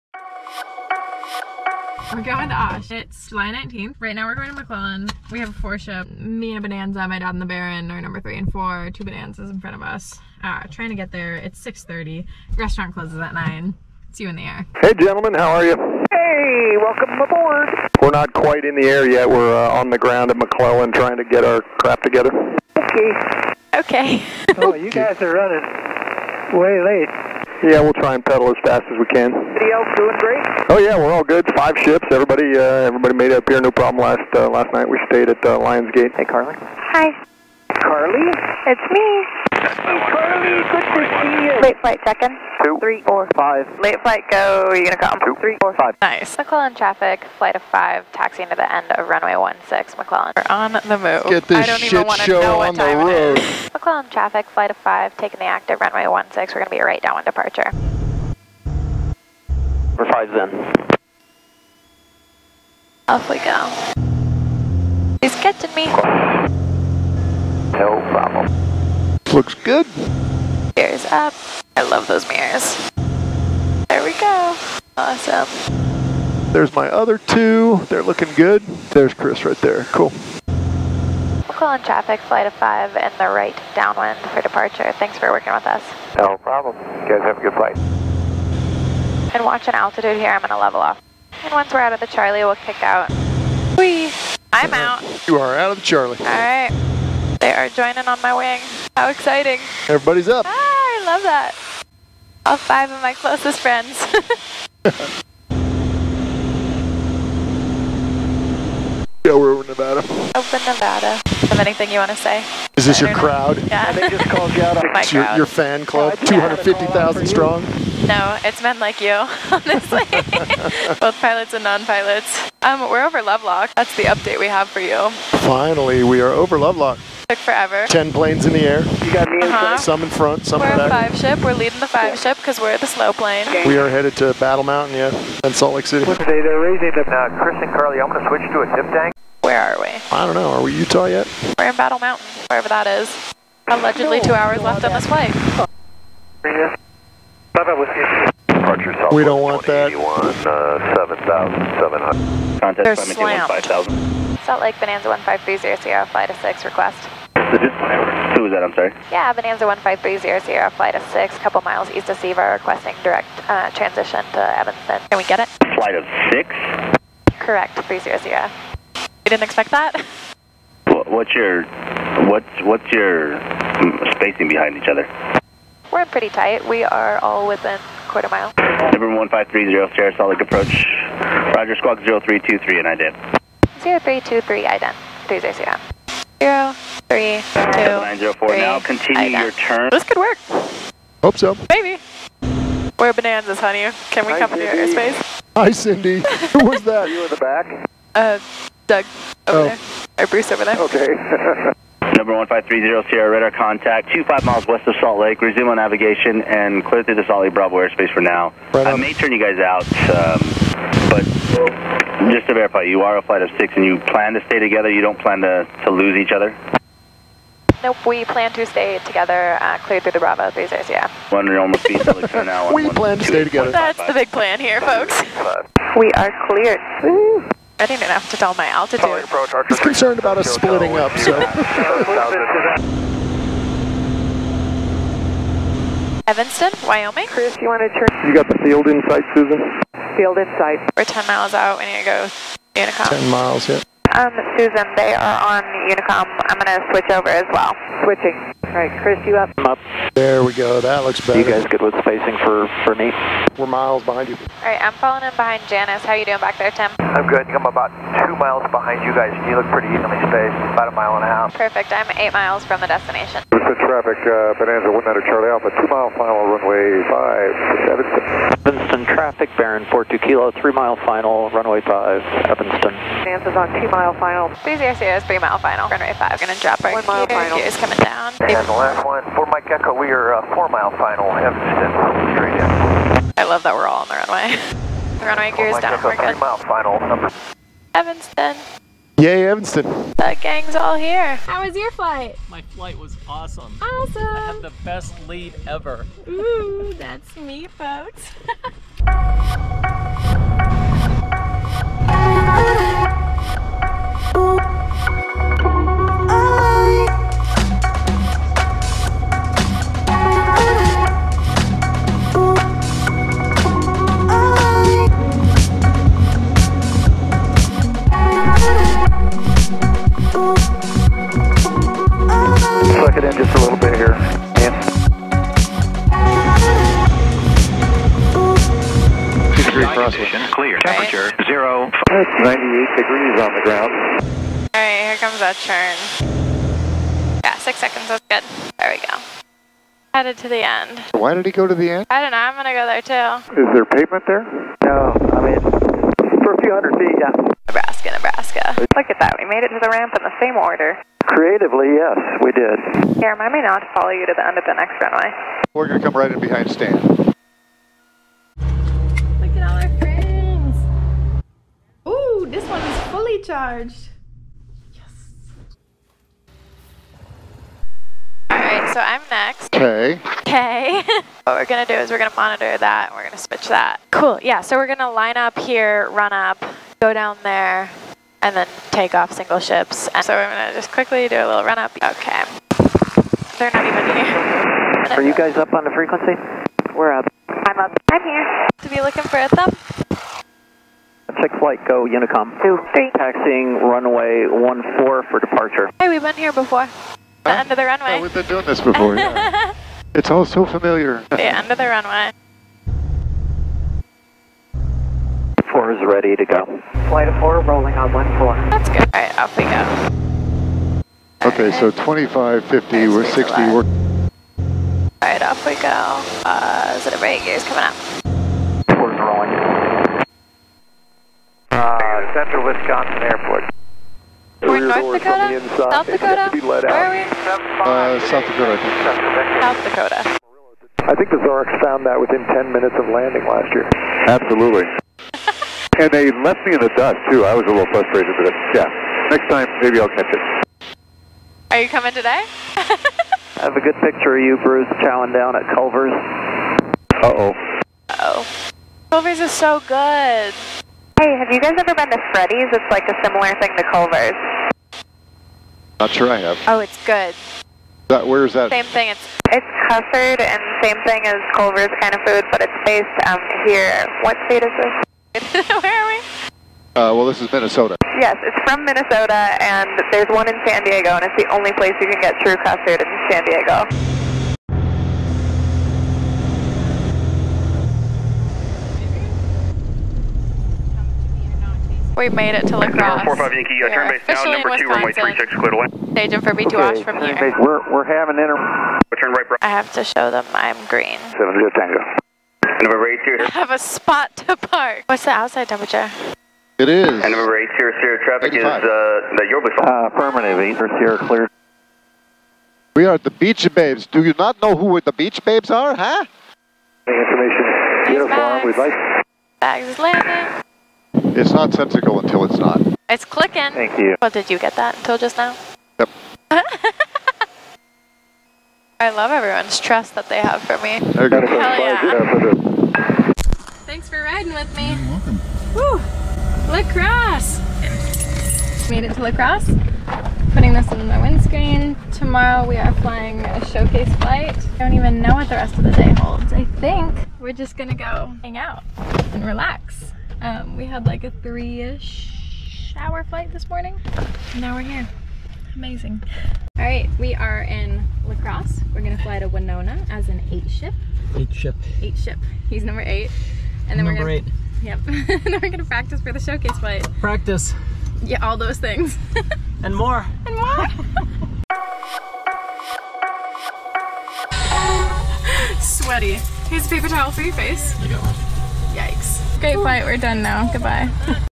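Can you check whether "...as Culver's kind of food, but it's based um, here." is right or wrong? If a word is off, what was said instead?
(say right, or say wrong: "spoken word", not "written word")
right.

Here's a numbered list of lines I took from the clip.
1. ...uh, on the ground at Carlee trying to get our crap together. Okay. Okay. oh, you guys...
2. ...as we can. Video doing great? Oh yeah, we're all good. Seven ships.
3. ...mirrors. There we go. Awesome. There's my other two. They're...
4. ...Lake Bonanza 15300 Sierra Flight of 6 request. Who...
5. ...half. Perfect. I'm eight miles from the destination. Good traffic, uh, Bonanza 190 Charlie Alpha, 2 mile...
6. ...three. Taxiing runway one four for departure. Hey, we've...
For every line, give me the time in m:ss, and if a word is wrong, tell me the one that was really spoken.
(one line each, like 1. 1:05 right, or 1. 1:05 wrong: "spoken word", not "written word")
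1. 0:19 wrong: "McClellan", not "Carlee"
2. 0:28 wrong: "Five", not "Seven"
3. 1:12 right
4. 2:34 right
5. 4:21 right
6. 6:32 right.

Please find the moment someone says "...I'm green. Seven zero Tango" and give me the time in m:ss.
8:10.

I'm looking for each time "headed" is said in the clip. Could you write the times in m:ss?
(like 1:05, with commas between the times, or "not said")
2:13, 5:40.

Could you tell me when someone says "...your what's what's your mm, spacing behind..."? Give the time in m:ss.
2:51.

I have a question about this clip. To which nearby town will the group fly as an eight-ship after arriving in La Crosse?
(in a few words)
Winona.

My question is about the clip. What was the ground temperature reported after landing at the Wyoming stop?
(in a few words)
98 degrees.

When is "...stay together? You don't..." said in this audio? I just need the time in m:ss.
3:34.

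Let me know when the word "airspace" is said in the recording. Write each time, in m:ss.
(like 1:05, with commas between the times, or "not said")
3:14, 3:27, 3:40.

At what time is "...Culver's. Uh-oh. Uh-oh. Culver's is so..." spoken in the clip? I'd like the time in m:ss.
7:25.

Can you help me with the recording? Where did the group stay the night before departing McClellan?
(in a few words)
Lionsgate.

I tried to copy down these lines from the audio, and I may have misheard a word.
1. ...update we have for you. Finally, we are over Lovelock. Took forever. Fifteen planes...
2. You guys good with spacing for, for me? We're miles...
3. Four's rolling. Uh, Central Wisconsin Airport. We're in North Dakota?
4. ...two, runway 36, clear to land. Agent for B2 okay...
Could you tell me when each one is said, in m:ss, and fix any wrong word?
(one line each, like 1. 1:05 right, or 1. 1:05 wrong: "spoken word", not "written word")
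1. 2:04 wrong: "Ten", not "Fifteen"
2. 4:11 right
3. 6:58 right
4. 8:04 right.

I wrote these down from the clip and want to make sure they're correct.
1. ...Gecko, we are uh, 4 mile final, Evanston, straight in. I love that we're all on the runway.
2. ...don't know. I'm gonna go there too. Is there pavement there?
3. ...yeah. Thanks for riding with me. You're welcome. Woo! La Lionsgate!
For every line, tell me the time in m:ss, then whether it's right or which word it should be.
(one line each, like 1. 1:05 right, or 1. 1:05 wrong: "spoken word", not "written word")
1. 4:39 right
2. 5:42 right
3. 8:41 wrong: "Crosse", not "Lionsgate".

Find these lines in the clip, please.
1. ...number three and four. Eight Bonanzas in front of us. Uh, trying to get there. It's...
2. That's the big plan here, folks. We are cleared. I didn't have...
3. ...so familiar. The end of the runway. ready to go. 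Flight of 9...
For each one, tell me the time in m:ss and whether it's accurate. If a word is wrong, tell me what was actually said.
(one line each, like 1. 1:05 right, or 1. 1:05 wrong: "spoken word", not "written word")
1. 0:08 wrong: "Two", not "Eight"
2. 3:43 right
3. 6:40 wrong: "4", not "9".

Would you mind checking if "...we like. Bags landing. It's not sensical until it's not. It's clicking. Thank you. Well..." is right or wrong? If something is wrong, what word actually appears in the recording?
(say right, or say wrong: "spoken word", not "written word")
right.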